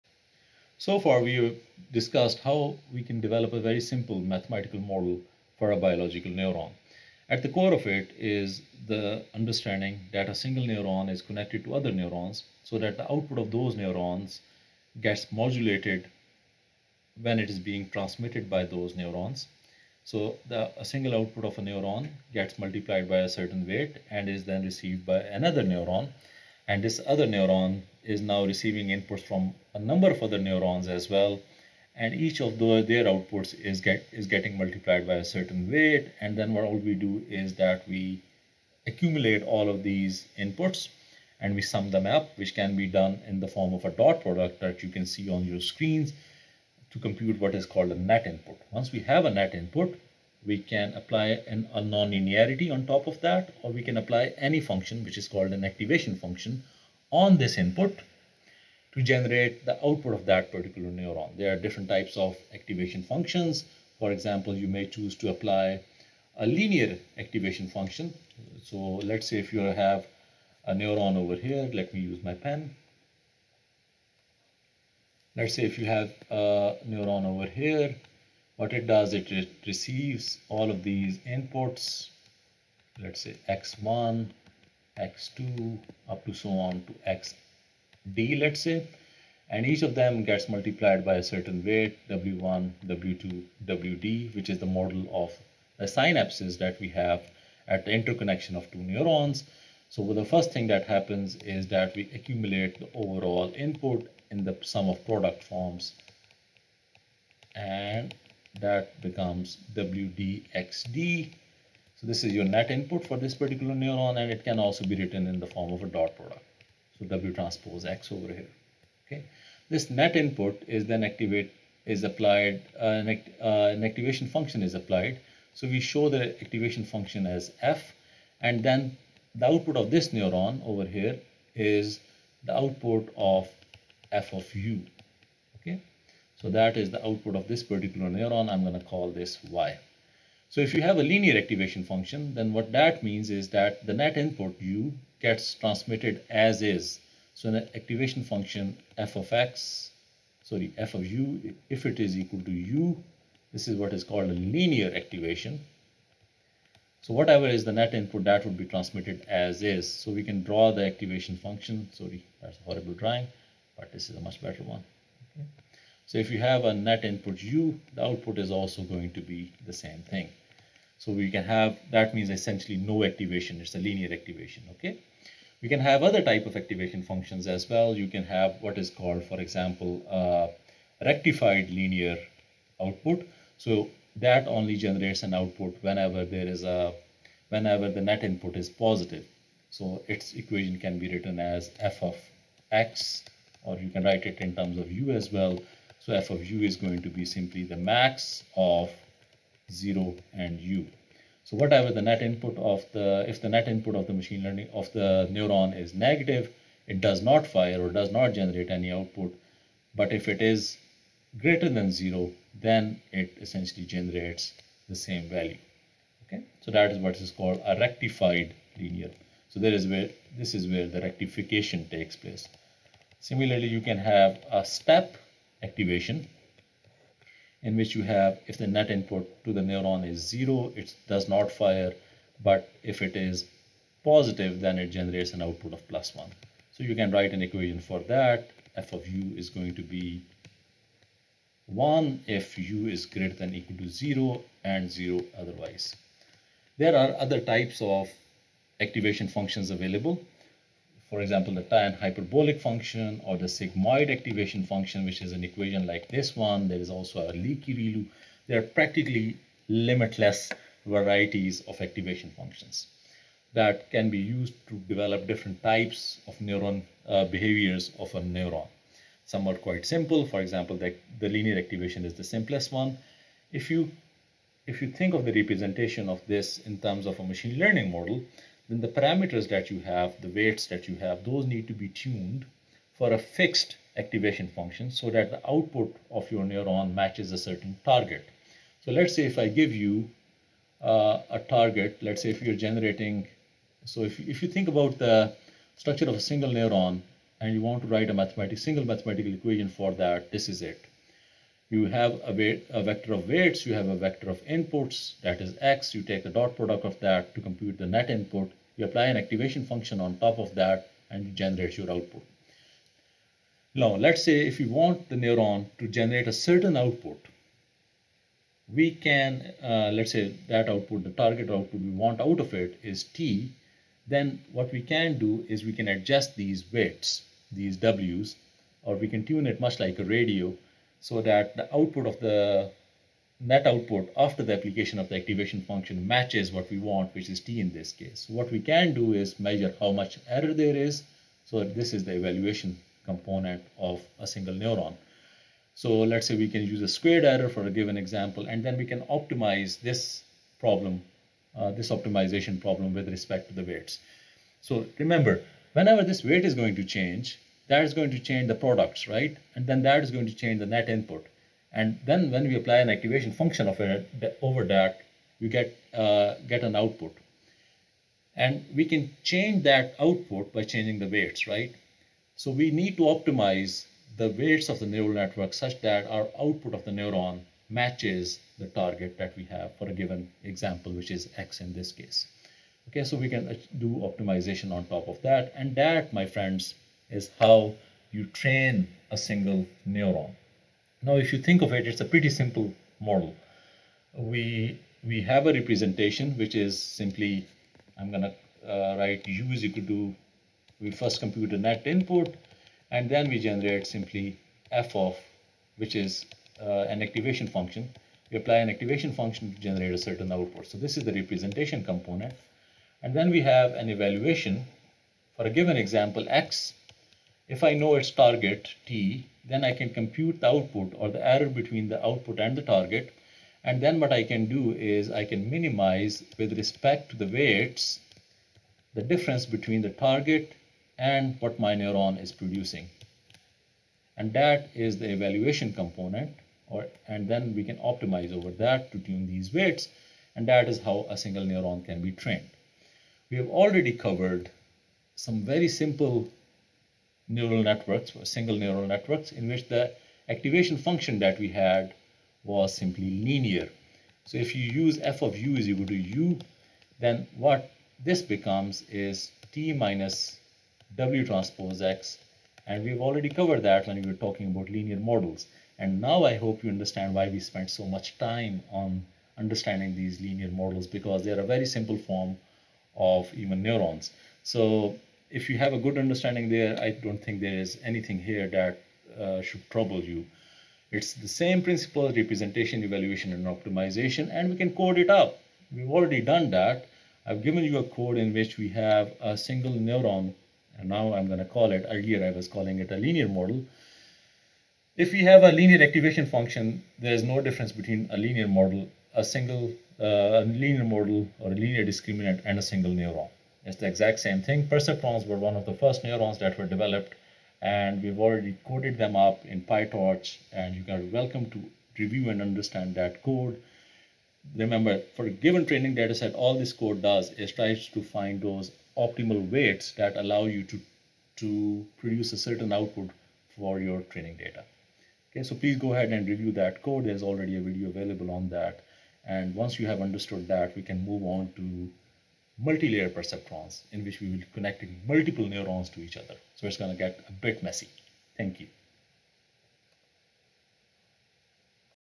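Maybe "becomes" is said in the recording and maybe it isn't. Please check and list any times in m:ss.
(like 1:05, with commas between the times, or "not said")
1:49, 7:38.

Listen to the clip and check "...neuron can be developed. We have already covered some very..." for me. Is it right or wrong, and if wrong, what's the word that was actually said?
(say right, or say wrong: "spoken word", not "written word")
wrong: "trained", not "developed".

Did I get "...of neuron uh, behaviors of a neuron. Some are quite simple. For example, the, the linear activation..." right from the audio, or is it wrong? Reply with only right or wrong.
right.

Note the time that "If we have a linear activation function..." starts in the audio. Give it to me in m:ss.
8:14.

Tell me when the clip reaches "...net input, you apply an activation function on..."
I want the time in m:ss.
5:07.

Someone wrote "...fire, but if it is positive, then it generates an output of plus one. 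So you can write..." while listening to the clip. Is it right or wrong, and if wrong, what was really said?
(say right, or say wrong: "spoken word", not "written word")
right.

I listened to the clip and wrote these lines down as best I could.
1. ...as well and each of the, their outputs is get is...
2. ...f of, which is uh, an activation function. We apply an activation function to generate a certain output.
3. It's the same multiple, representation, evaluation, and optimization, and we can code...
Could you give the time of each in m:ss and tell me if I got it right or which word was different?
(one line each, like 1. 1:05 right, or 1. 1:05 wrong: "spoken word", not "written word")
1. 0:30 right
2. 6:44 right
3. 8:00 wrong: "principle", not "multiple".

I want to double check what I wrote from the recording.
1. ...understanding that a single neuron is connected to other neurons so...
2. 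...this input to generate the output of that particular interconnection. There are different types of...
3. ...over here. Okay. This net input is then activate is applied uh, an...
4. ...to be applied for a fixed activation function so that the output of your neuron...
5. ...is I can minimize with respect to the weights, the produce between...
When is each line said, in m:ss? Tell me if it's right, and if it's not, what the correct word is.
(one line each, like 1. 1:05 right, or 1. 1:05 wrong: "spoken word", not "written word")
1. 0:09 right
2. 0:57 wrong: "neuron", not "interconnection"
3. 1:58 right
4. 4:41 wrong: "tuned", not "applied"
5. 7:04 wrong: "difference", not "produce".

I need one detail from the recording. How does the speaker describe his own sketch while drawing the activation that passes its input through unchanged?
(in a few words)
a horrible drawing.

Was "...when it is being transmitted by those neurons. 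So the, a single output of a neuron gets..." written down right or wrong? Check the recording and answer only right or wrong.
right.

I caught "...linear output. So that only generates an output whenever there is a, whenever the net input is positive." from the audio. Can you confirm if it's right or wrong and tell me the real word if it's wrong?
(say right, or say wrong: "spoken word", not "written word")
right.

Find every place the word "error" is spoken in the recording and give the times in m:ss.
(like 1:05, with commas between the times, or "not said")
5:40, 5:47, 7:01.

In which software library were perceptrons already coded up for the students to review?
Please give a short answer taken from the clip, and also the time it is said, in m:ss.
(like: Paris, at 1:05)
PyTorch, at 8:29.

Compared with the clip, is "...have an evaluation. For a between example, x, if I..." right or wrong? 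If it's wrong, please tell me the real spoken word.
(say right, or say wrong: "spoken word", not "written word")
wrong: "given", not "between".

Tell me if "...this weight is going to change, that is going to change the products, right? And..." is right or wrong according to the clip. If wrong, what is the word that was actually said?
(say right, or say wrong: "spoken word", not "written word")
right.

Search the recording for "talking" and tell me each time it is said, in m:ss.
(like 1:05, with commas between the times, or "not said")
7:44.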